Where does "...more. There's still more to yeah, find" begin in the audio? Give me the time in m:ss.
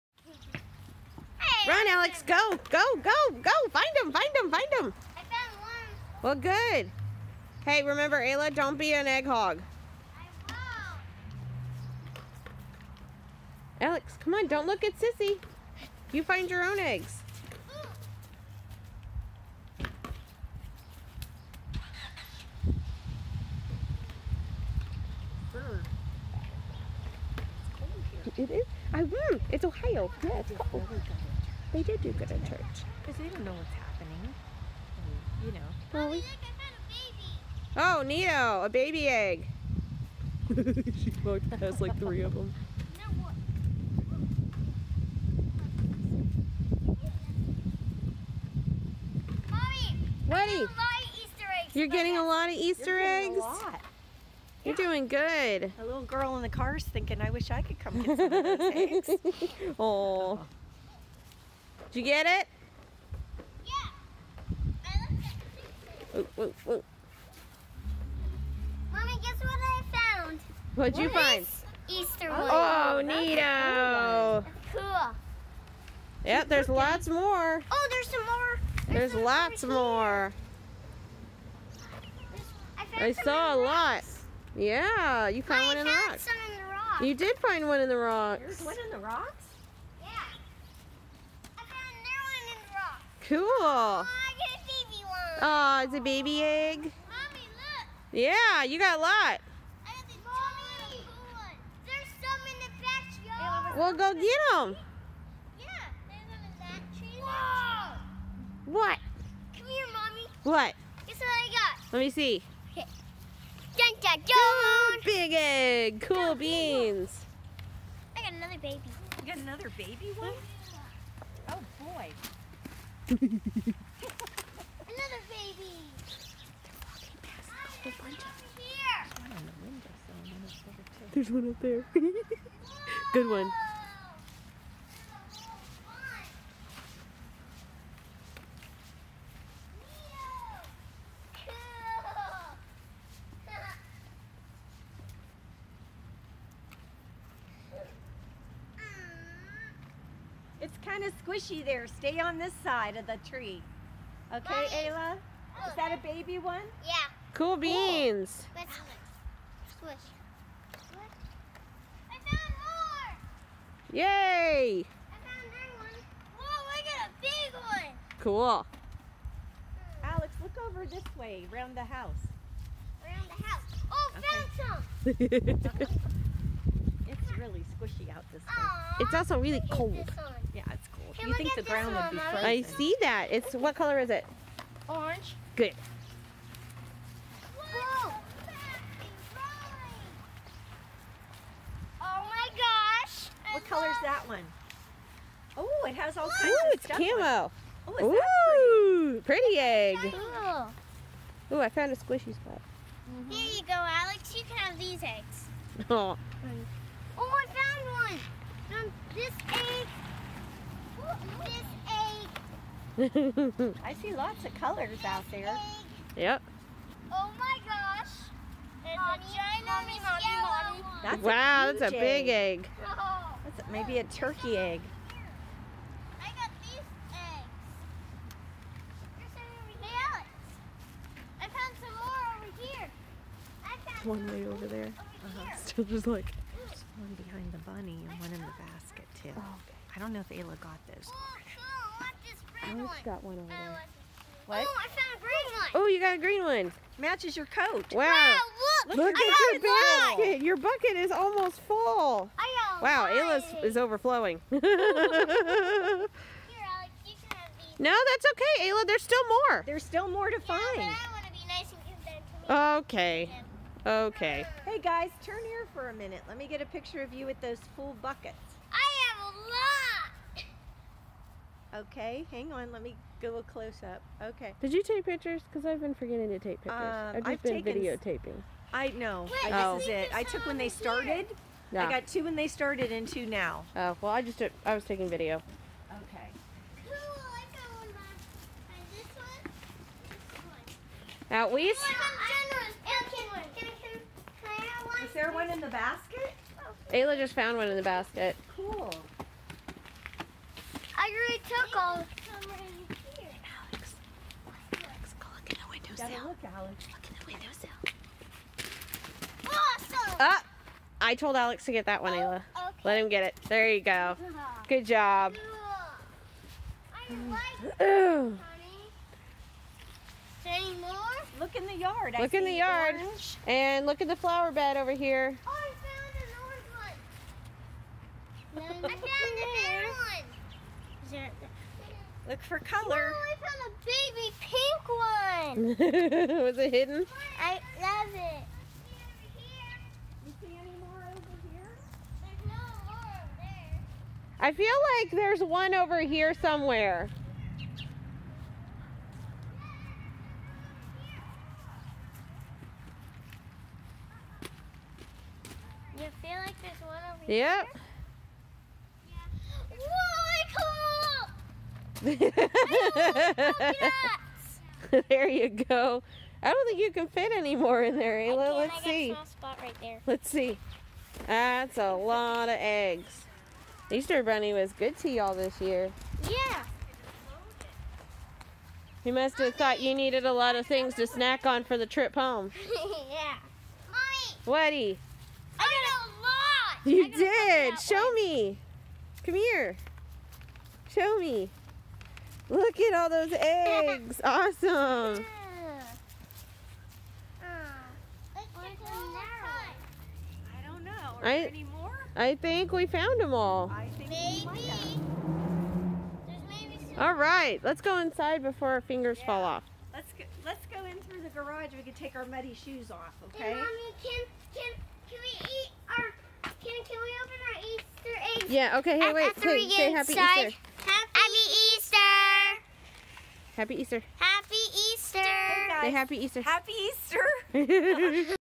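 4:19.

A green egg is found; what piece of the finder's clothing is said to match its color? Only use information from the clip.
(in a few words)
Coat.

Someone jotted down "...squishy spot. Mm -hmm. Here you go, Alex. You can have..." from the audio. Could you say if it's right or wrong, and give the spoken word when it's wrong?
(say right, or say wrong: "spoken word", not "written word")
right.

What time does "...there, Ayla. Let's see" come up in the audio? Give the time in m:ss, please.
6:07.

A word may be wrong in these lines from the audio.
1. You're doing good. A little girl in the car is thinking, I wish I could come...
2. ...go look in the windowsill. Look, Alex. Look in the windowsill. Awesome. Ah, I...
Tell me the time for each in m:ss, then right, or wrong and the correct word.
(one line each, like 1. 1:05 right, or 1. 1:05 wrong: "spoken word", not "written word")
1. 0:54 right
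2. 5:05 right.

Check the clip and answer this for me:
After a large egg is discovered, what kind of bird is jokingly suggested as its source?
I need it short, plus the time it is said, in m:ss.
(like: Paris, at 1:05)
Turkey, at 3:44.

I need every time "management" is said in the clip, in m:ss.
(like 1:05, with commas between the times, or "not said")
not said.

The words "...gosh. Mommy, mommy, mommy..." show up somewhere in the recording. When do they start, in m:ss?
3:37.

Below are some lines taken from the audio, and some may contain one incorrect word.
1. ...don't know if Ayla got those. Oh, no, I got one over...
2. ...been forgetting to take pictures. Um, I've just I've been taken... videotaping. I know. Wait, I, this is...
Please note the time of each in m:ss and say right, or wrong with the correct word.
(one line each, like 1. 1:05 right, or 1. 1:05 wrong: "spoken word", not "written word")
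1. 3:59 right
2. 4:35 right.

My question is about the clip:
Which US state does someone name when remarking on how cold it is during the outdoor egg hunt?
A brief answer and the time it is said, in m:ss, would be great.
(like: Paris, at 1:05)
Ohio, at 0:29.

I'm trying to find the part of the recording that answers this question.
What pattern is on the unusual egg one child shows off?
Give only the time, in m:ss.
3:18.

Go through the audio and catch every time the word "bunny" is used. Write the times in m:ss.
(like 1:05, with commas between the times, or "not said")
3:57, 6:14.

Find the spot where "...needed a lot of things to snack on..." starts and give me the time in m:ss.
6:19.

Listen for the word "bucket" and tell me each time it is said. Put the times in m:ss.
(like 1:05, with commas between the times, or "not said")
4:10, 4:28.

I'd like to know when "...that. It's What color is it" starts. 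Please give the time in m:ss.
3:03.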